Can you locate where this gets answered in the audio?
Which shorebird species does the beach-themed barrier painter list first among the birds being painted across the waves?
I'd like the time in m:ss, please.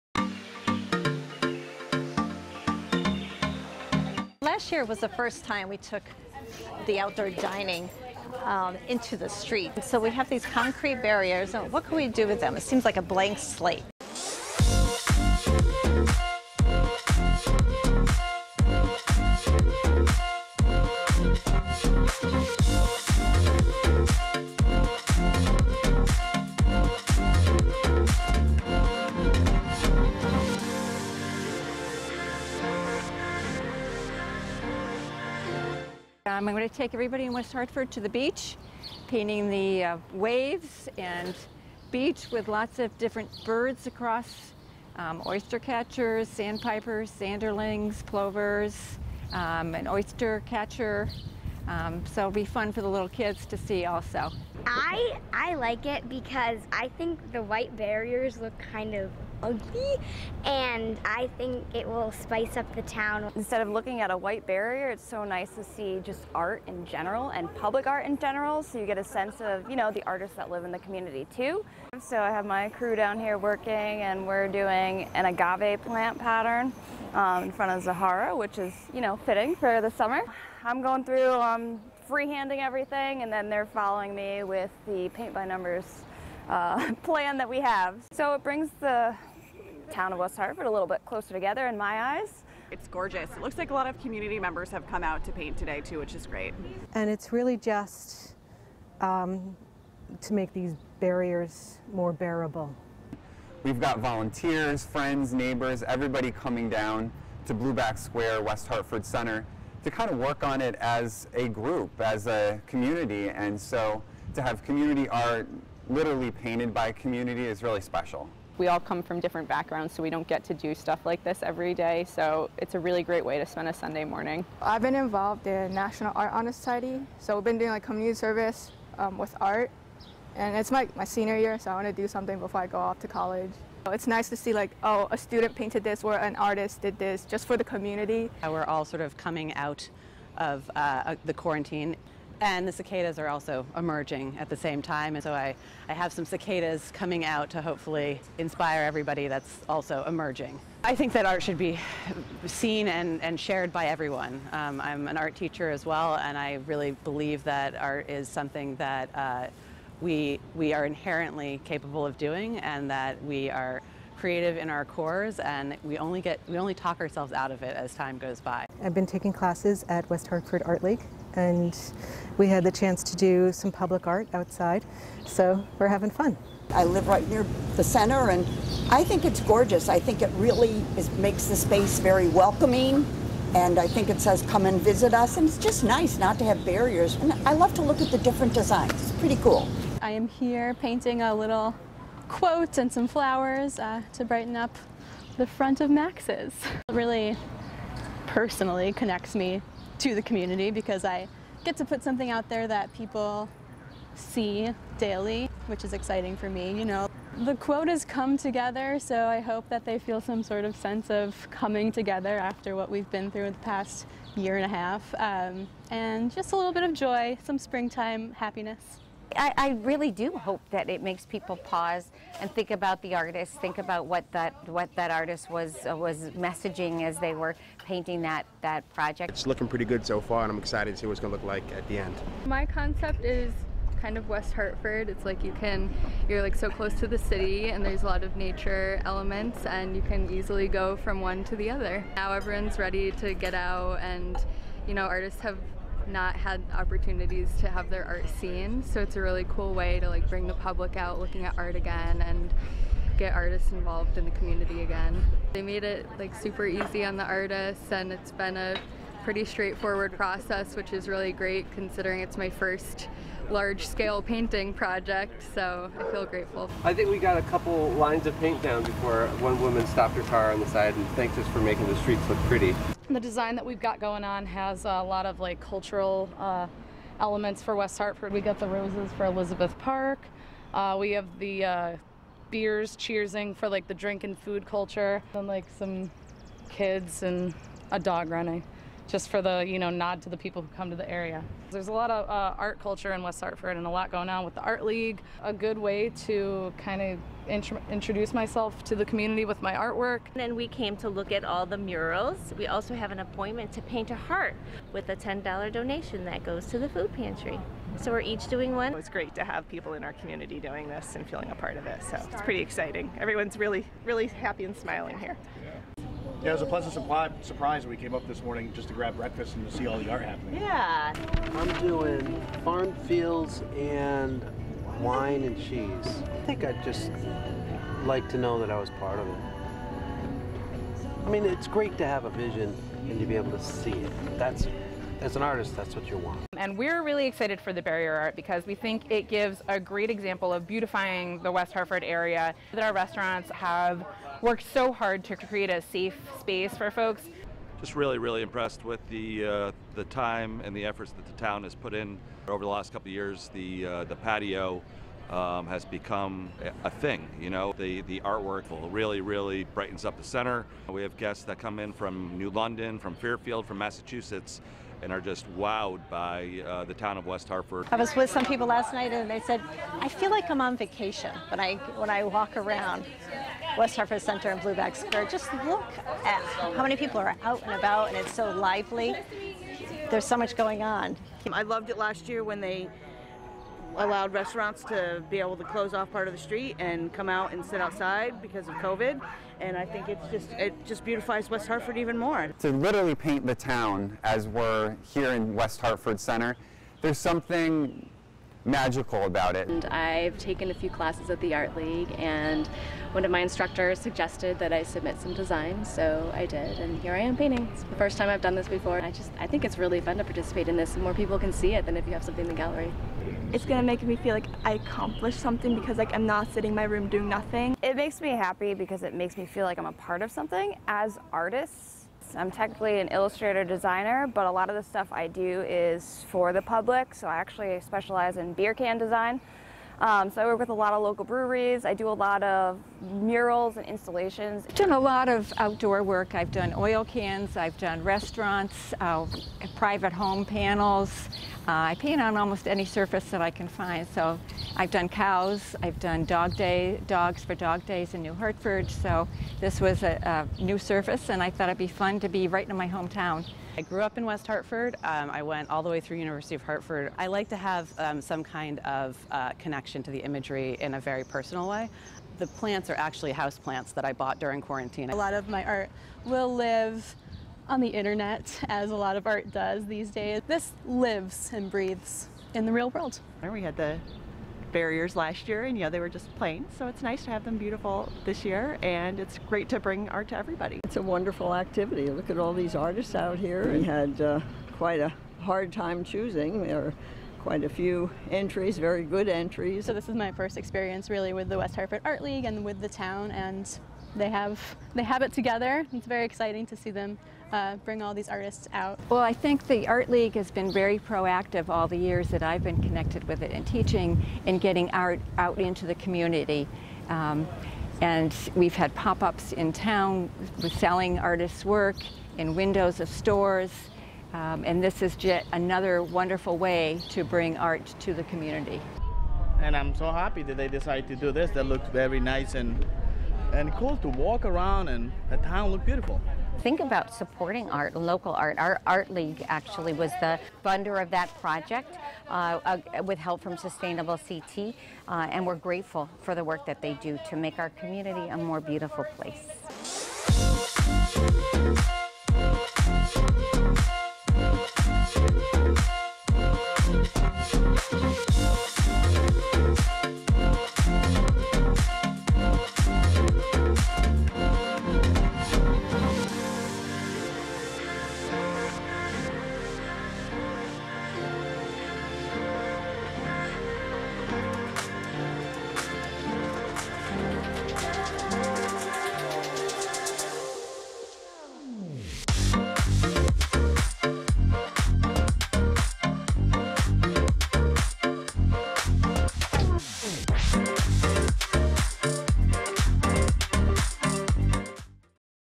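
0:45.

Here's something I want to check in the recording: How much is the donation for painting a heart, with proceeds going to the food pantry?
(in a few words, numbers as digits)
$10.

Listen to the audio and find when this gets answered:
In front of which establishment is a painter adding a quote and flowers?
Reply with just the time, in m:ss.
3:15.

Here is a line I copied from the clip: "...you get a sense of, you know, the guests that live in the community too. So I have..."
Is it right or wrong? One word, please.
wrong.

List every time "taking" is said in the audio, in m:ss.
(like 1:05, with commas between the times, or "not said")
2:49.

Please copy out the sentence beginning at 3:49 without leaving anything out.
It's looking pretty good so far, and I'm excited to see what's going to look like at the end.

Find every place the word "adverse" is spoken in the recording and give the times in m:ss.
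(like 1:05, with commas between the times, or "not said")
not said.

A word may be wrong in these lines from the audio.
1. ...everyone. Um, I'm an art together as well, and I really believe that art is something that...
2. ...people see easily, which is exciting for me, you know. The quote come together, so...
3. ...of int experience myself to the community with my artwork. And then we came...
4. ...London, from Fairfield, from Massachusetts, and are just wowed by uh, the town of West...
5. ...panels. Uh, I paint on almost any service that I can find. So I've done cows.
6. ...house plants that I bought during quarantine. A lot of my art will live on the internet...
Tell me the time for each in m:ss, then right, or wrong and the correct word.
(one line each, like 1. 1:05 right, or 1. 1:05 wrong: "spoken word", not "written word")
1. 2:33 wrong: "teacher", not "together"
2. 3:22 wrong: "daily", not "easily"
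3. 4:57 wrong: "introduce", not "experience"
4. 6:02 right
5. 7:20 wrong: "surface", not "service"
6. 7:43 right.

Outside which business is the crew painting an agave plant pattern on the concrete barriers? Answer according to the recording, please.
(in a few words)
Zahara.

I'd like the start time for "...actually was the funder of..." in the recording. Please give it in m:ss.
8:49.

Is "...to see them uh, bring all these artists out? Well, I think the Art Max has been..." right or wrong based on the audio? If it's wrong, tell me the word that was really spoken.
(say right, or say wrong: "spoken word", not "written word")
wrong: "League", not "Max".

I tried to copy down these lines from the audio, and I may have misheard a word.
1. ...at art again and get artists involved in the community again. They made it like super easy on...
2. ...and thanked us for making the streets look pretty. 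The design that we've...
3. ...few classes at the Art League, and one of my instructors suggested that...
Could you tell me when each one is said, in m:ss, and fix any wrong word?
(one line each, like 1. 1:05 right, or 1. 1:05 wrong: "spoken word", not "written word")
1. 4:11 right
2. 4:30 right
3. 6:40 right.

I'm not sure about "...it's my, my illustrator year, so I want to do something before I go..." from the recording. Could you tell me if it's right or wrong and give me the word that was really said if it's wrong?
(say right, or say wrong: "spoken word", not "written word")
wrong: "senior", not "illustrator".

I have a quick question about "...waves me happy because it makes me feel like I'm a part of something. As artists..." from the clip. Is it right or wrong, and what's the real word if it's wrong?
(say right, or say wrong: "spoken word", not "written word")
wrong: "makes", not "waves".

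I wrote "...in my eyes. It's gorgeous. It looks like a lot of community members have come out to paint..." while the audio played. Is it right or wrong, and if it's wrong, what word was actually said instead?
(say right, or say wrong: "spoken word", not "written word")
right.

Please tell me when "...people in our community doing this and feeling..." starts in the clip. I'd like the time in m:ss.
5:09.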